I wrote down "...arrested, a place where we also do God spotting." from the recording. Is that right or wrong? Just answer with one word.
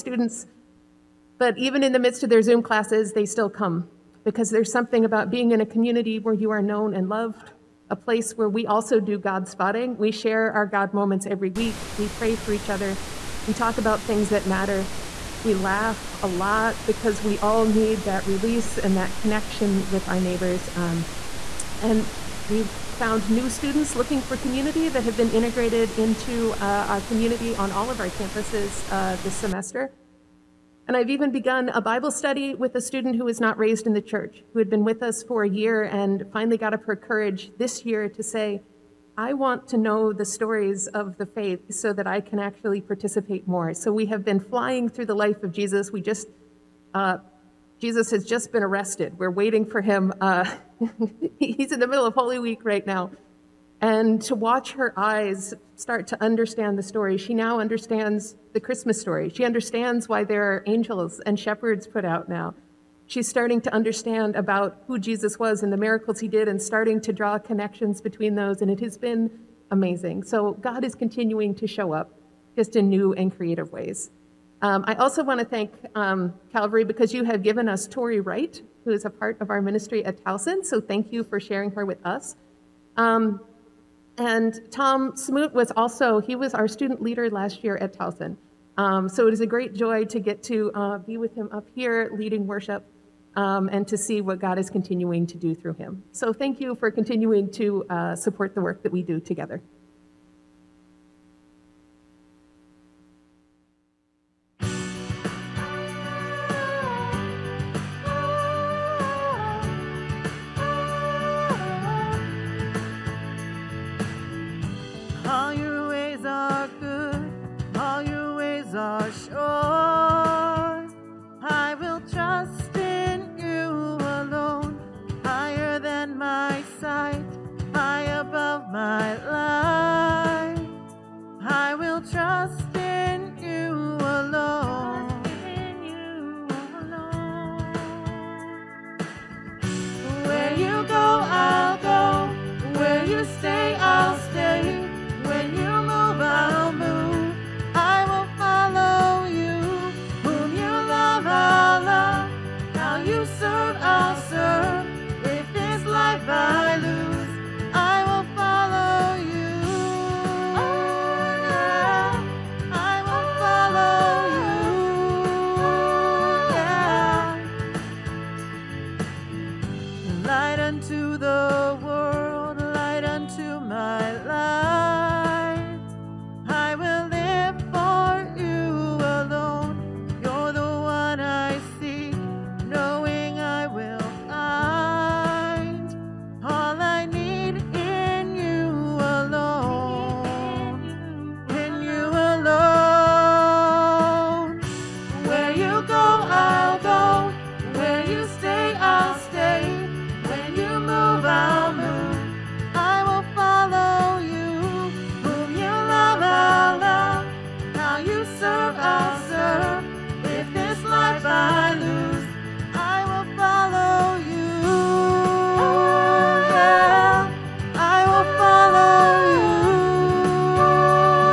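wrong.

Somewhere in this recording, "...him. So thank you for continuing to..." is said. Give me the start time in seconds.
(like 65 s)
95 s.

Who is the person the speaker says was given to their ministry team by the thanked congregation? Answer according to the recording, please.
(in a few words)
Tori Wright.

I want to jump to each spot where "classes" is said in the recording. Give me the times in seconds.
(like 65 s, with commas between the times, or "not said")
2 s.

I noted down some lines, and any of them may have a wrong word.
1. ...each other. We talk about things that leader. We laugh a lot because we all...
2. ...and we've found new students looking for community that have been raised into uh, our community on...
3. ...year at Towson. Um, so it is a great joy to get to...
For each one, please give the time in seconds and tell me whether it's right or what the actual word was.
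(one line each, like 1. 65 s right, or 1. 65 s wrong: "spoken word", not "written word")
1. 12 s wrong: "matter", not "leader"
2. 21 s wrong: "integrated", not "raised"
3. 87 s right.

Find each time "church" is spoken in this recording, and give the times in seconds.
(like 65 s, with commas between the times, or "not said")
33 s.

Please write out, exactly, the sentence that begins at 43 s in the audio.
So we have been flying through the life of Jesus.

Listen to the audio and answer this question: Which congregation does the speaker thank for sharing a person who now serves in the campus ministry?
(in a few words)
Calvary.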